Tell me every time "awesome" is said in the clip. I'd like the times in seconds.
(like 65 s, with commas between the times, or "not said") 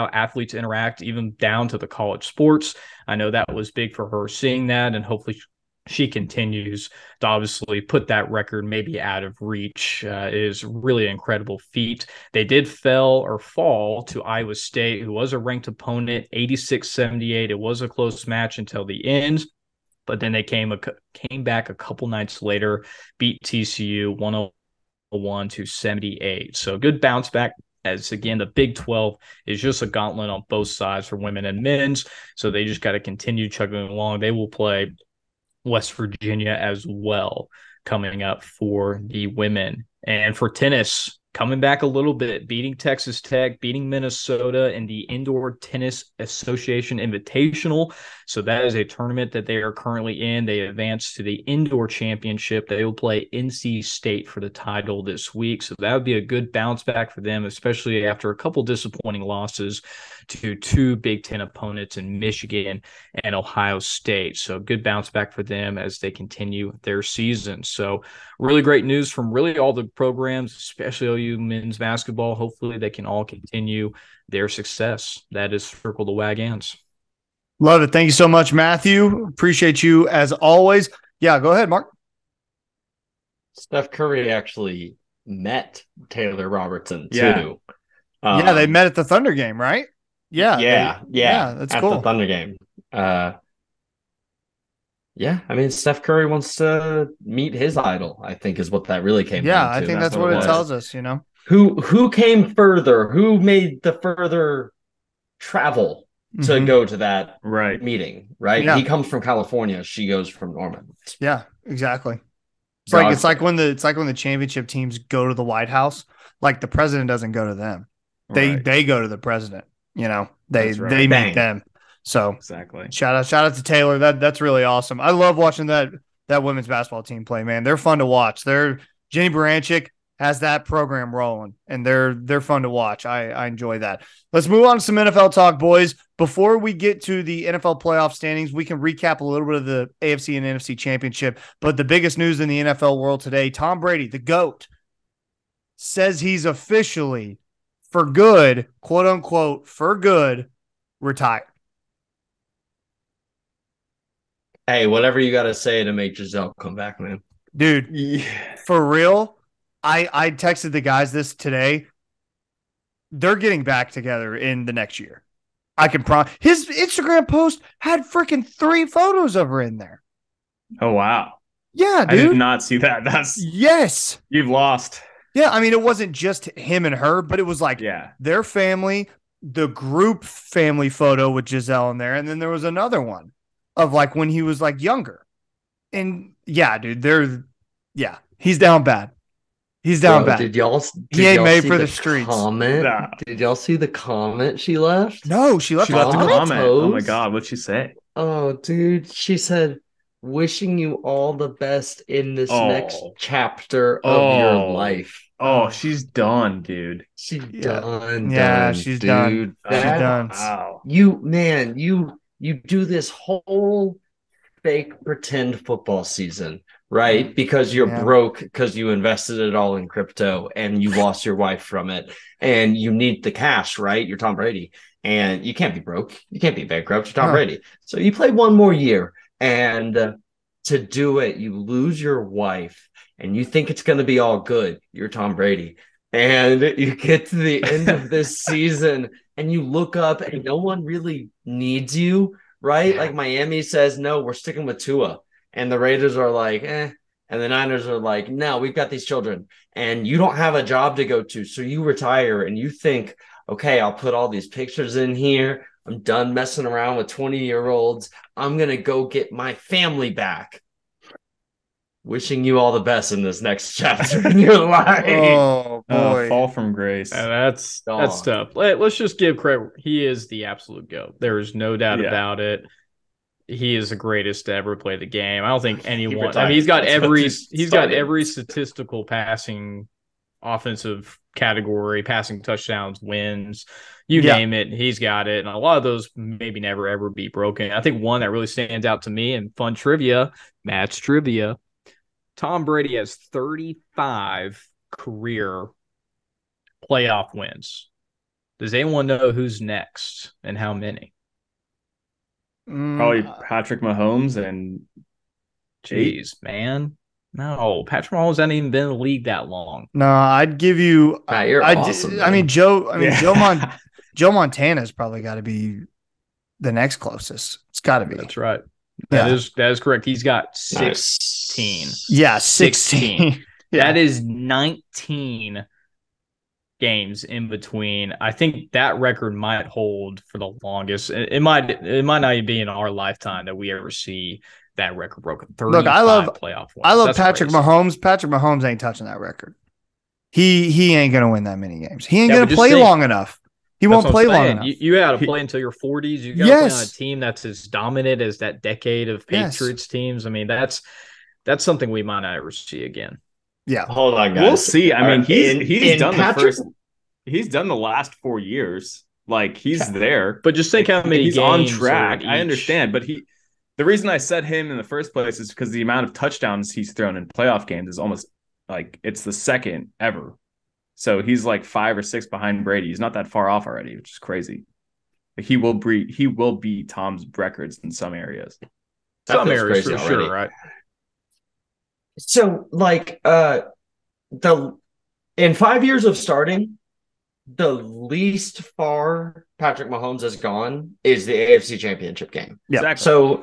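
124 s, 311 s.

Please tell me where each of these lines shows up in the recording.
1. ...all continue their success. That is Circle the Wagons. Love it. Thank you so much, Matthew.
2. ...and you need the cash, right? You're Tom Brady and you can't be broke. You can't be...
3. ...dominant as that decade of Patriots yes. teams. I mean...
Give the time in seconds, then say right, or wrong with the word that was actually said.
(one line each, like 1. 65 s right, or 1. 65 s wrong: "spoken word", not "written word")
1. 73 s right
2. 222 s right
3. 347 s right.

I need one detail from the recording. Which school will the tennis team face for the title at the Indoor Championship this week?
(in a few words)
NC State.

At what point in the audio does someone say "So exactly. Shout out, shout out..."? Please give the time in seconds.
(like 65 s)
122 s.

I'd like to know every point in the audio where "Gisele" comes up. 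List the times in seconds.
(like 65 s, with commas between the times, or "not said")
156 s, 181 s.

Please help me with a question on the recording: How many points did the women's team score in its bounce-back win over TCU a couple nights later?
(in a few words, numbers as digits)
101.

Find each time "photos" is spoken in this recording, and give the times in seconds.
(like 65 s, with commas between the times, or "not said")
168 s, 180 s.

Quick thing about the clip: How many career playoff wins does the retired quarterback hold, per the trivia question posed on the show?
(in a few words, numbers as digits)
35.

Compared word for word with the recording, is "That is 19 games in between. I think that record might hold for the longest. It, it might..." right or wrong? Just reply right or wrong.
right.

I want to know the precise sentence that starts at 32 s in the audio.
So they just got to continue chugging along.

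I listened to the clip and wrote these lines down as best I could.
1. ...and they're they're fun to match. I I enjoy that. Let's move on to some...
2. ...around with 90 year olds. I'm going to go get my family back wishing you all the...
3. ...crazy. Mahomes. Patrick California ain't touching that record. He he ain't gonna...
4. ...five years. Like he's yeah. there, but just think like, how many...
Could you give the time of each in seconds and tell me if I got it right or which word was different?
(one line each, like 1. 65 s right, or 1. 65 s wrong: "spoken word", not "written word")
1. 131 s wrong: "watch", not "match"
2. 256 s wrong: "20", not "90"
3. 337 s wrong: "Mahomes", not "California"
4. 358 s wrong: "four", not "five".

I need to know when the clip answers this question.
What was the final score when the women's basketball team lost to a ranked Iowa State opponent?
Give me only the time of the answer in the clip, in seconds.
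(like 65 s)
16 s.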